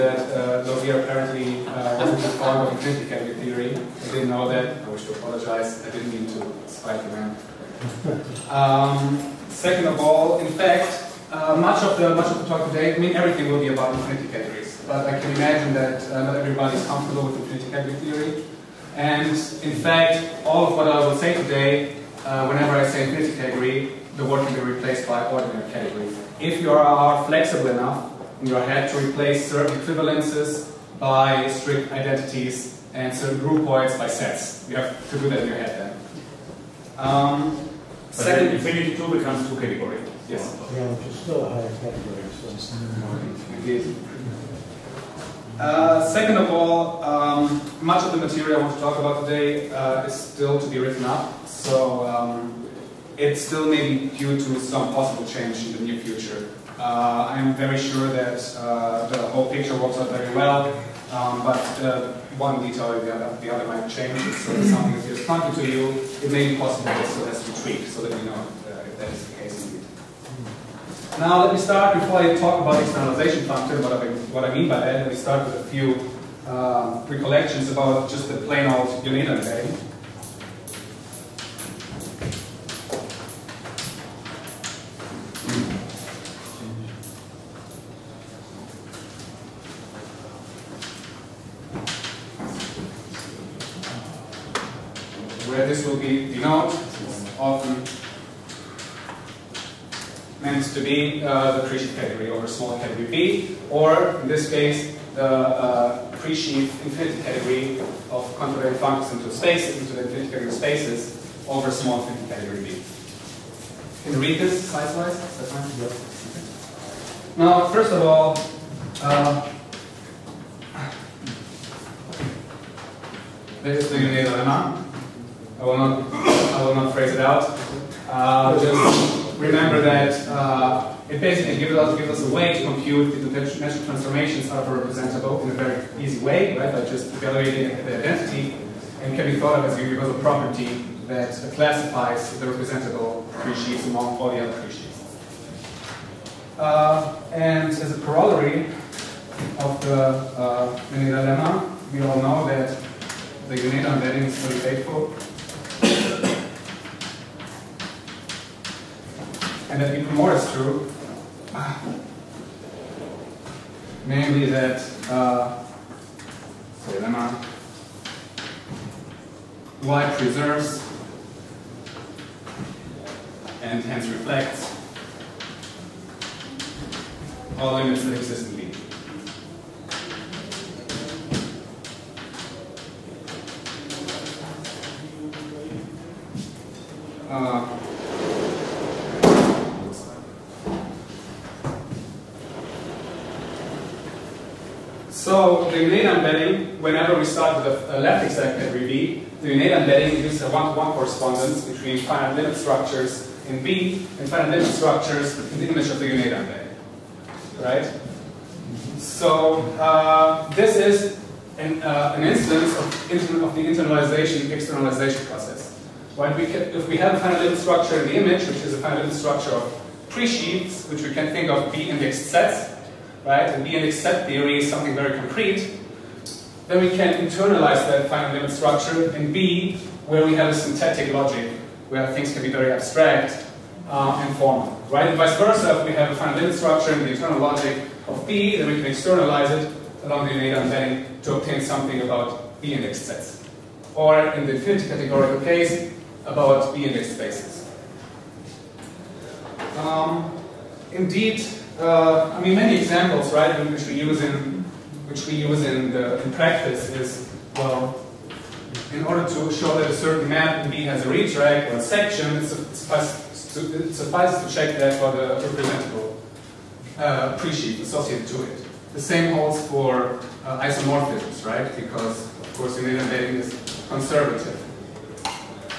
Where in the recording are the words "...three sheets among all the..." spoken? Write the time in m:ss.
2:23.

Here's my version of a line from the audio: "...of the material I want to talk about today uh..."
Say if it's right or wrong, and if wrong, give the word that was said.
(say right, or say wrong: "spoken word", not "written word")
right.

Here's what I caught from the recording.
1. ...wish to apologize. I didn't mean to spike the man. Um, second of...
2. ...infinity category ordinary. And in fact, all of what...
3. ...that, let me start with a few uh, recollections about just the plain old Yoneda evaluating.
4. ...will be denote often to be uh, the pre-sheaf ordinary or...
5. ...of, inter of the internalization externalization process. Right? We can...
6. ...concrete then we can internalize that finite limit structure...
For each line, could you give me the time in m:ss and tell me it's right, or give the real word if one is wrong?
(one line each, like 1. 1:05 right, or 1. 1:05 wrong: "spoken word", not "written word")
1. 0:04 right
2. 0:17 wrong: "theory", not "ordinary"
3. 1:14 wrong: "embedding", not "evaluating"
4. 1:35 wrong: "category", not "ordinary"
5. 3:32 right
6. 3:45 right.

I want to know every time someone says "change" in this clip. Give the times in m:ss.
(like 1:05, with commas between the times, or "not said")
0:55, 1:03.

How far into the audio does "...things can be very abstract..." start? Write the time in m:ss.
3:52.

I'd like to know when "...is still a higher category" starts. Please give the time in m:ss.
0:41.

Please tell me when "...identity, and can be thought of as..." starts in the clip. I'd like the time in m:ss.
2:17.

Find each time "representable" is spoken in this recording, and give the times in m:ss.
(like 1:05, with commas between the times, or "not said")
2:14, 2:22, 4:25.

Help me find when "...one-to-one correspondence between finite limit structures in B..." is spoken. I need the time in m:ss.
3:20.